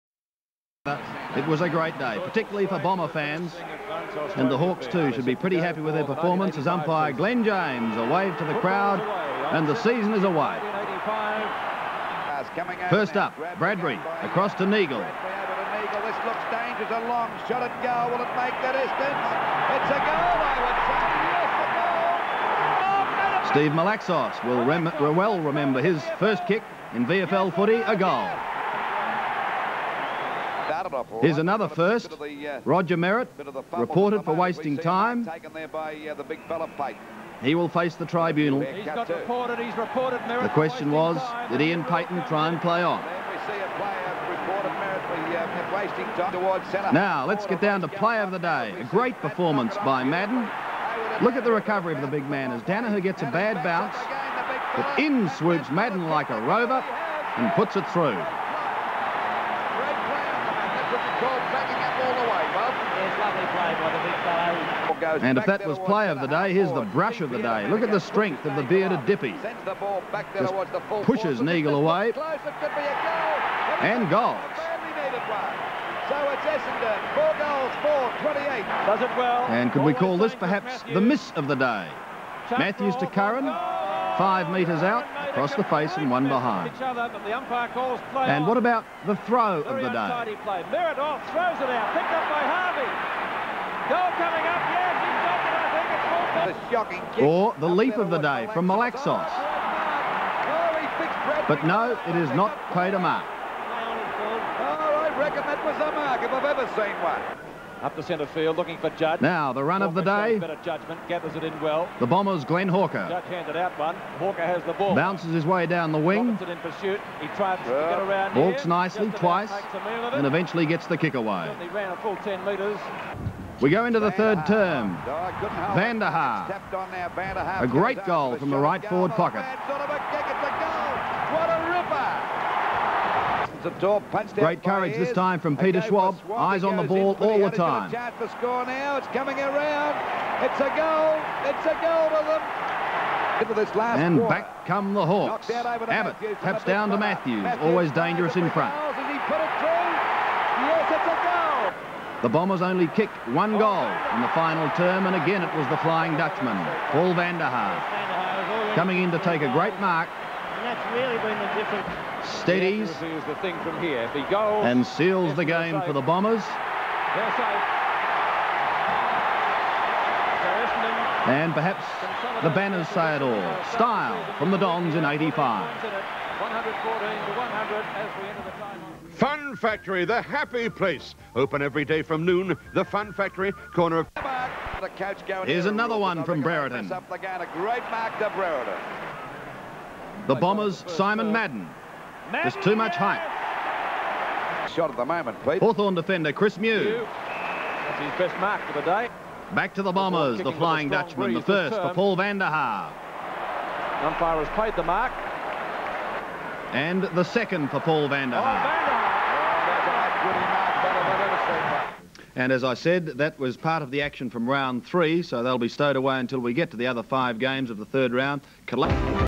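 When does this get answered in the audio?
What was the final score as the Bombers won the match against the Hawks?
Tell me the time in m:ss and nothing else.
2:55.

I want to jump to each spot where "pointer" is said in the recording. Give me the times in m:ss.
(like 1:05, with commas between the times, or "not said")
not said.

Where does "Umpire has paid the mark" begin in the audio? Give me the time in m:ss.
3:24.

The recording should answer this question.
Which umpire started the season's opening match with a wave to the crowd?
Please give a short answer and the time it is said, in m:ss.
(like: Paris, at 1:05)
Glenn James, at 0:07.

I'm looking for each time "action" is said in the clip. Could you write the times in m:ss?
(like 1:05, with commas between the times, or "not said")
3:34.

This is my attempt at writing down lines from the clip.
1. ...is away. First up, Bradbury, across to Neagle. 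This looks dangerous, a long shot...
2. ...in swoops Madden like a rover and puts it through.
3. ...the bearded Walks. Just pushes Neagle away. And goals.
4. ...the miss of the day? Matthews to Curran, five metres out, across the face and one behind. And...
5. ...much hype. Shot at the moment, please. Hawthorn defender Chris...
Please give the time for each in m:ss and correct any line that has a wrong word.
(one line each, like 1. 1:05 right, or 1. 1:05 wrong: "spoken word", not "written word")
1. 0:10 right
2. 0:54 right
3. 1:08 wrong: "Dippy", not "Walks"
4. 1:20 right
5. 3:12 right.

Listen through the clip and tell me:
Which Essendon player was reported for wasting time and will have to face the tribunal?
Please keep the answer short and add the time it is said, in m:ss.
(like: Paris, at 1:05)
Roger Merrett, at 0:32.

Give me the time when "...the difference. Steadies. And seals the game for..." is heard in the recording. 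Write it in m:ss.
2:41.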